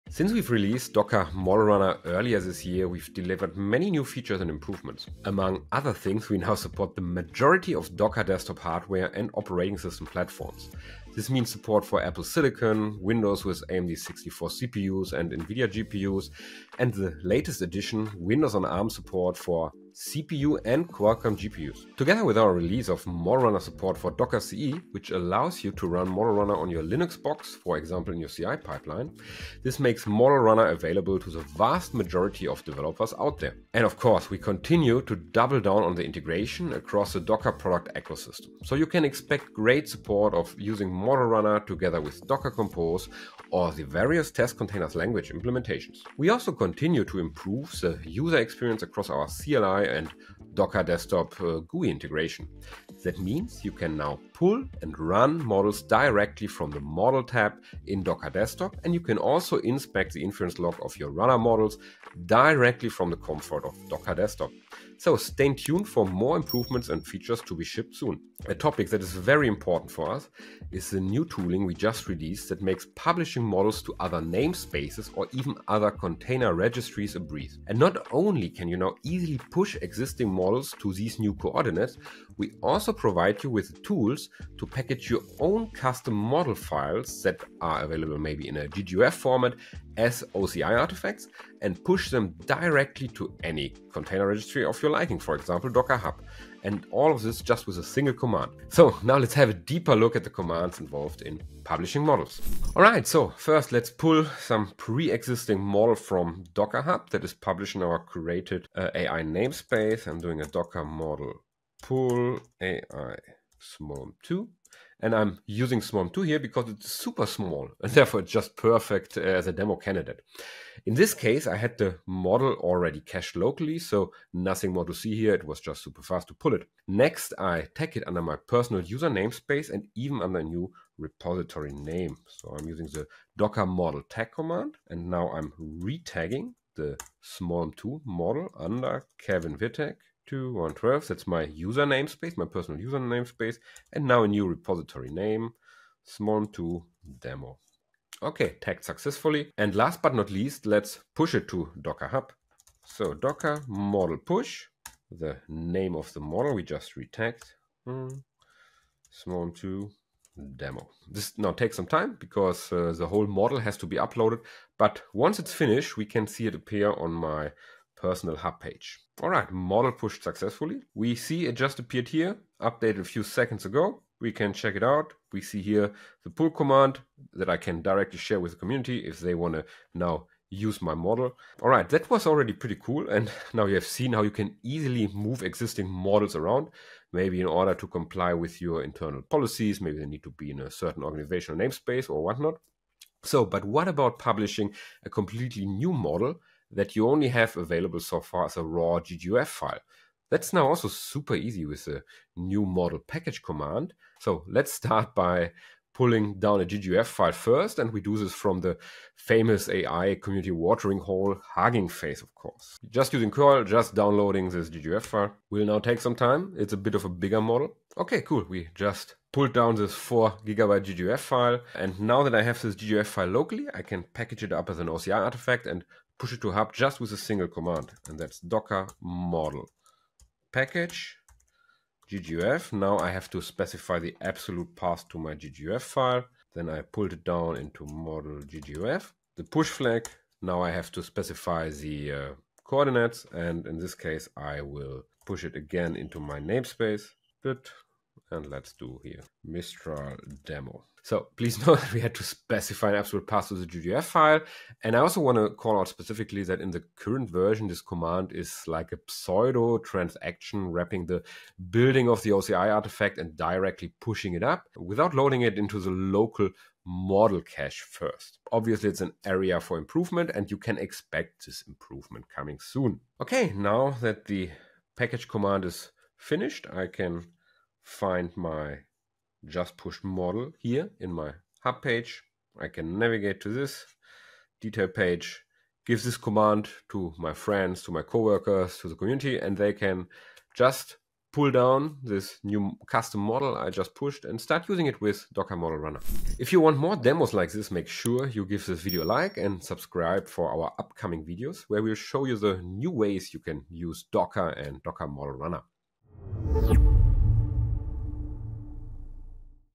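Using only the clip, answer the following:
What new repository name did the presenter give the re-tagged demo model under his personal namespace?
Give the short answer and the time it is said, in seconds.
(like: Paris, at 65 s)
small 2 demo, at 146 s.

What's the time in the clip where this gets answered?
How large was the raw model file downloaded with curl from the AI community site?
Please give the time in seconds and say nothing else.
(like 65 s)
219 s.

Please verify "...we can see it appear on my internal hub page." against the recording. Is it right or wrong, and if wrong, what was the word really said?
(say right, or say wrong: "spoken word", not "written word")
wrong: "personal", not "internal".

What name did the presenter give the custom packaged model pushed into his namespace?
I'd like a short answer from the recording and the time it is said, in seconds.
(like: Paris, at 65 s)
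Mistral demo, at 249 s.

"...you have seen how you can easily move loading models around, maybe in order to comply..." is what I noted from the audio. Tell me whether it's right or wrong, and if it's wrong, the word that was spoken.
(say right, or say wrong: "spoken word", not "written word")
wrong: "existing", not "loading".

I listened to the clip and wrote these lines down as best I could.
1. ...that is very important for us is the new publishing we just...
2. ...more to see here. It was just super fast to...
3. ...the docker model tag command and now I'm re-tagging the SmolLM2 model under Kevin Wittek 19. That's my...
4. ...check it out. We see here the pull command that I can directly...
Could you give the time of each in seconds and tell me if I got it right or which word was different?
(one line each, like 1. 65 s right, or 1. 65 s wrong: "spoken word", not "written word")
1. 68 s wrong: "tooling", not "publishing"
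2. 124 s right
3. 132 s wrong: "12", not "19"
4. 174 s right.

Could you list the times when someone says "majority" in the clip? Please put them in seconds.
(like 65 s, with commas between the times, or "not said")
7 s, 31 s.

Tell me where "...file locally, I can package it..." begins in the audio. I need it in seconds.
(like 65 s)
223 s.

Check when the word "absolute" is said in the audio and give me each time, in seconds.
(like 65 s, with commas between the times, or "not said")
234 s, 252 s.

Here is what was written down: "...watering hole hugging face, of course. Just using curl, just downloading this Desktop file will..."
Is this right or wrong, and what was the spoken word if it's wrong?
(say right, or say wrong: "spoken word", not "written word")
wrong: "GGUF", not "Desktop".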